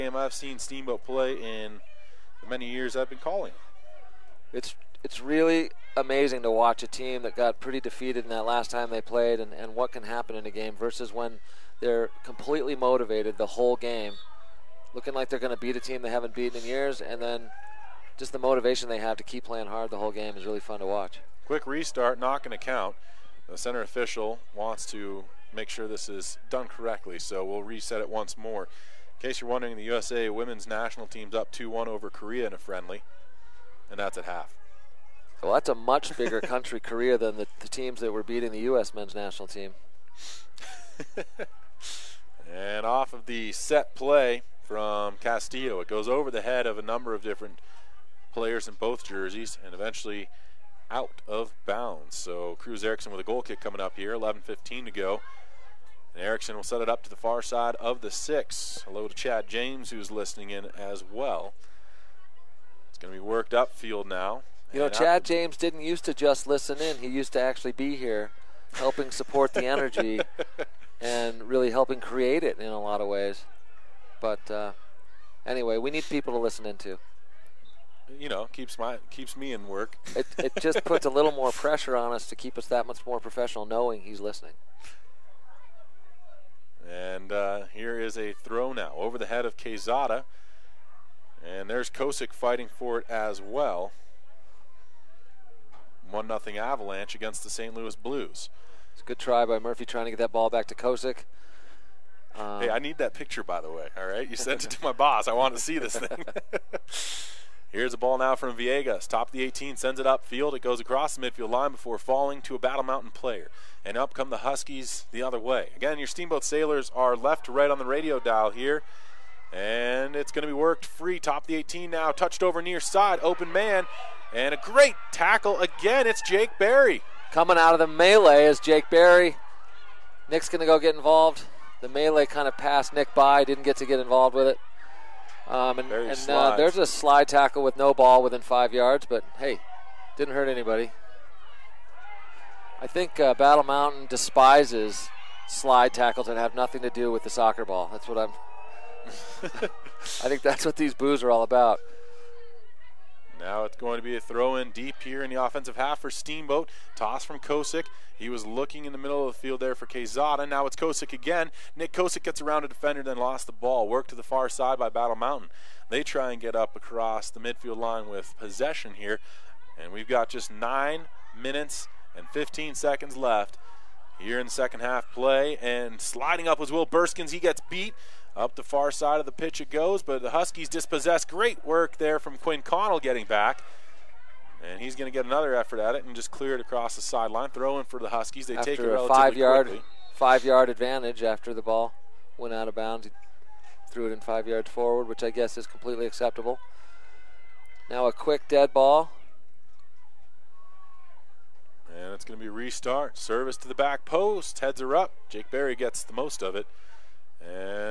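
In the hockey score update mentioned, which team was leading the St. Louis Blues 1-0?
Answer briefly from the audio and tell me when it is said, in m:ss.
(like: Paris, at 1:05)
Avalanche, at 1:36.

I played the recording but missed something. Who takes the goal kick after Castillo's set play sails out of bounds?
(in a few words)
Cruz Erickson.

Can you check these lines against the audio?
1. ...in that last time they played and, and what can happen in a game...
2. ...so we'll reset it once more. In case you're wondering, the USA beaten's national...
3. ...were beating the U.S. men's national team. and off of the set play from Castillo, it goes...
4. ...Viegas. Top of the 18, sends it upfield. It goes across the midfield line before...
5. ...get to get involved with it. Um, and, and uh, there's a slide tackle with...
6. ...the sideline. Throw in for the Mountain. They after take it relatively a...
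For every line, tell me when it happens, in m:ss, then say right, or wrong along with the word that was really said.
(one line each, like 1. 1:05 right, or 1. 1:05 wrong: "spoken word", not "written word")
1. 0:08 right
2. 0:27 wrong: "women", not "beaten"
3. 0:38 right
4. 1:48 right
5. 2:13 right
6. 3:06 wrong: "Huskies", not "Mountain".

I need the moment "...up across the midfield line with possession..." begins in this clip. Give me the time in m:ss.
2:46.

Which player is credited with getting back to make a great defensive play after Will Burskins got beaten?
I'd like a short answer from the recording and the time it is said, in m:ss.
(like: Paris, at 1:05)
Quinn Connell, at 3:02.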